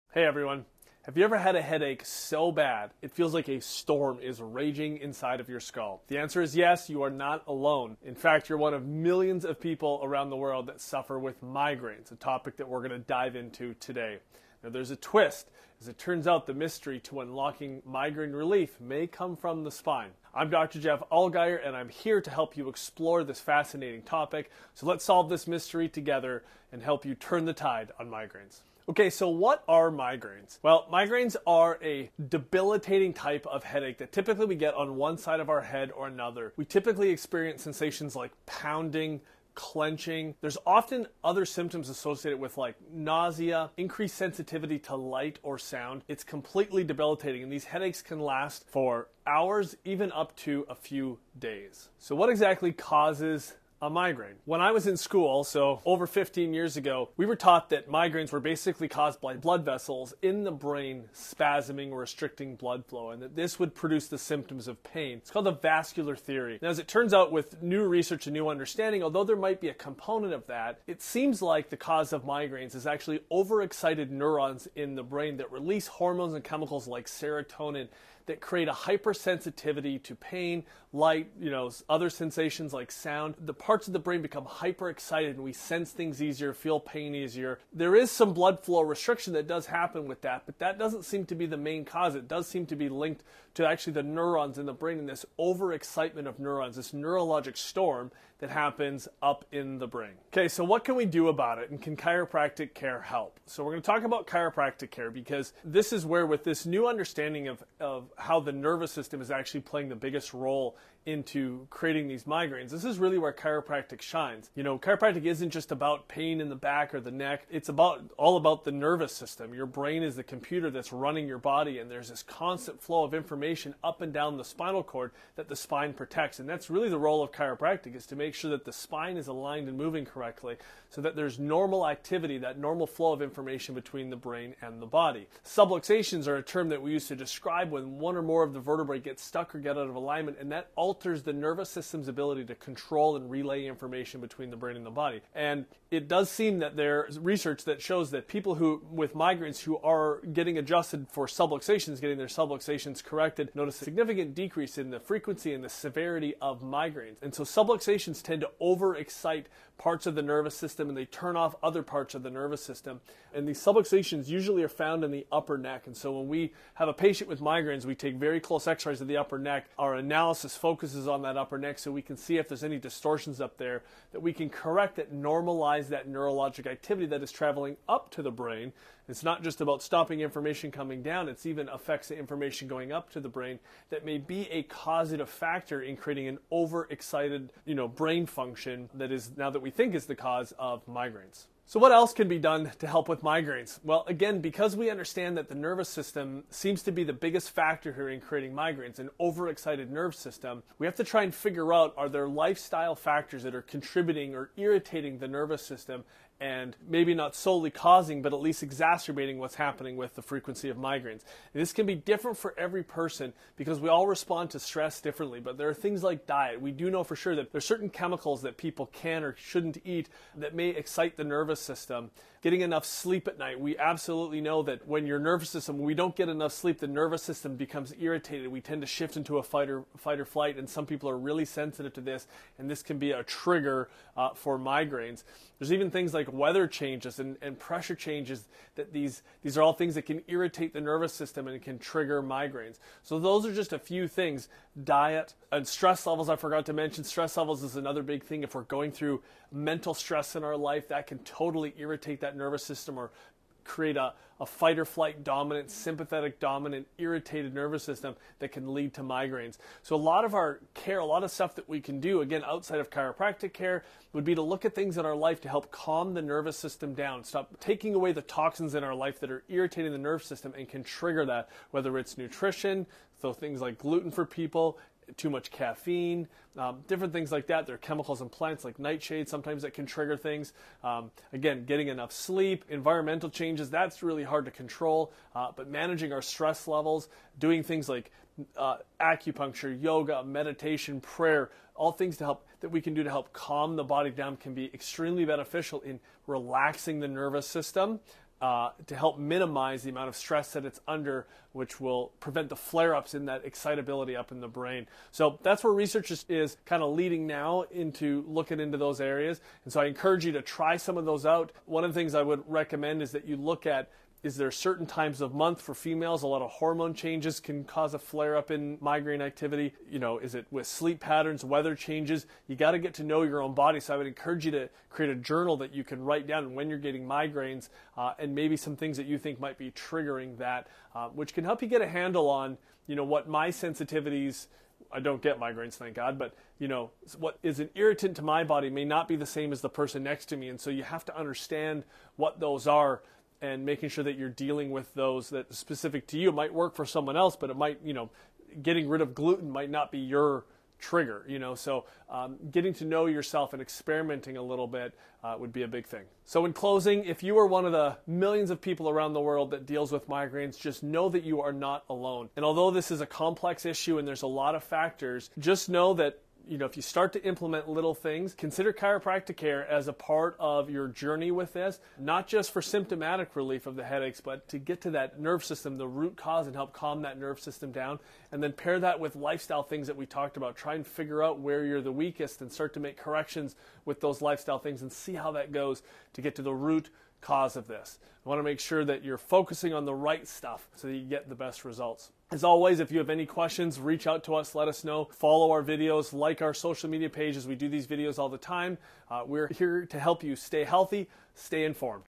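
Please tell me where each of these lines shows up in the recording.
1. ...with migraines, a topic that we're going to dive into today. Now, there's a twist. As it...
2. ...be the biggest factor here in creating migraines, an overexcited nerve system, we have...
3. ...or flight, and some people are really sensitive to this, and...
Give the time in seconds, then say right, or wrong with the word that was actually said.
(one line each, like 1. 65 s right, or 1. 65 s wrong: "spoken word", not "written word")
1. 11 s right
2. 196 s right
3. 230 s right.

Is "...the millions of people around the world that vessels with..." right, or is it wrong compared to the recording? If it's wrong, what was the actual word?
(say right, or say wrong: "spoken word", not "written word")
wrong: "deals", not "vessels".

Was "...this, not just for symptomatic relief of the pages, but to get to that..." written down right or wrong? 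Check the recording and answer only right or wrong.
wrong.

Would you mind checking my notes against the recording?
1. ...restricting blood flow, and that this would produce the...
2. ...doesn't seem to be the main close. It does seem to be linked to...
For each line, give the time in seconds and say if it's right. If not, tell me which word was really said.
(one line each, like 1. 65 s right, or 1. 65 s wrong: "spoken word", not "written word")
1. 62 s right
2. 90 s wrong: "cause", not "close".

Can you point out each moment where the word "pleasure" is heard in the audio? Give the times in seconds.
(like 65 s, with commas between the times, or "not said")
not said.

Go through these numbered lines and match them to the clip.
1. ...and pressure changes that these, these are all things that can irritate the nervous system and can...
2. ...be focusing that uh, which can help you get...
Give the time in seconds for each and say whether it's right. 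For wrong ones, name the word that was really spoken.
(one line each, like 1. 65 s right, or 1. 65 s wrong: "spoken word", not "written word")
1. 237 s right
2. 329 s wrong: "triggering", not "focusing".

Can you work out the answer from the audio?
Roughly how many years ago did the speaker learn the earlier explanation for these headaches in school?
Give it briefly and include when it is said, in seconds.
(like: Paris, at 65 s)
15, at 56 s.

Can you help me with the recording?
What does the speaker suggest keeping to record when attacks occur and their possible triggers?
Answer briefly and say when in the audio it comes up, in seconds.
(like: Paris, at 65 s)
a journal, at 325 s.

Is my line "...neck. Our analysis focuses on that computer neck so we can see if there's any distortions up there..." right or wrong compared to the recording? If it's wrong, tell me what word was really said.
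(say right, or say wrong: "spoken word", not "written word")
wrong: "upper", not "computer".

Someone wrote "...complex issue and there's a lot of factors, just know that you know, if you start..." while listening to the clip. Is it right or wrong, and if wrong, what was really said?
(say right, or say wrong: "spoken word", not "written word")
right.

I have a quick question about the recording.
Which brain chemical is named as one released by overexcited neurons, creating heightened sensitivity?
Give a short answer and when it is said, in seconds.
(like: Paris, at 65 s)
serotonin, at 77 s.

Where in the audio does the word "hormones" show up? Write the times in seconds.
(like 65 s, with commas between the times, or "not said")
75 s, 316 s.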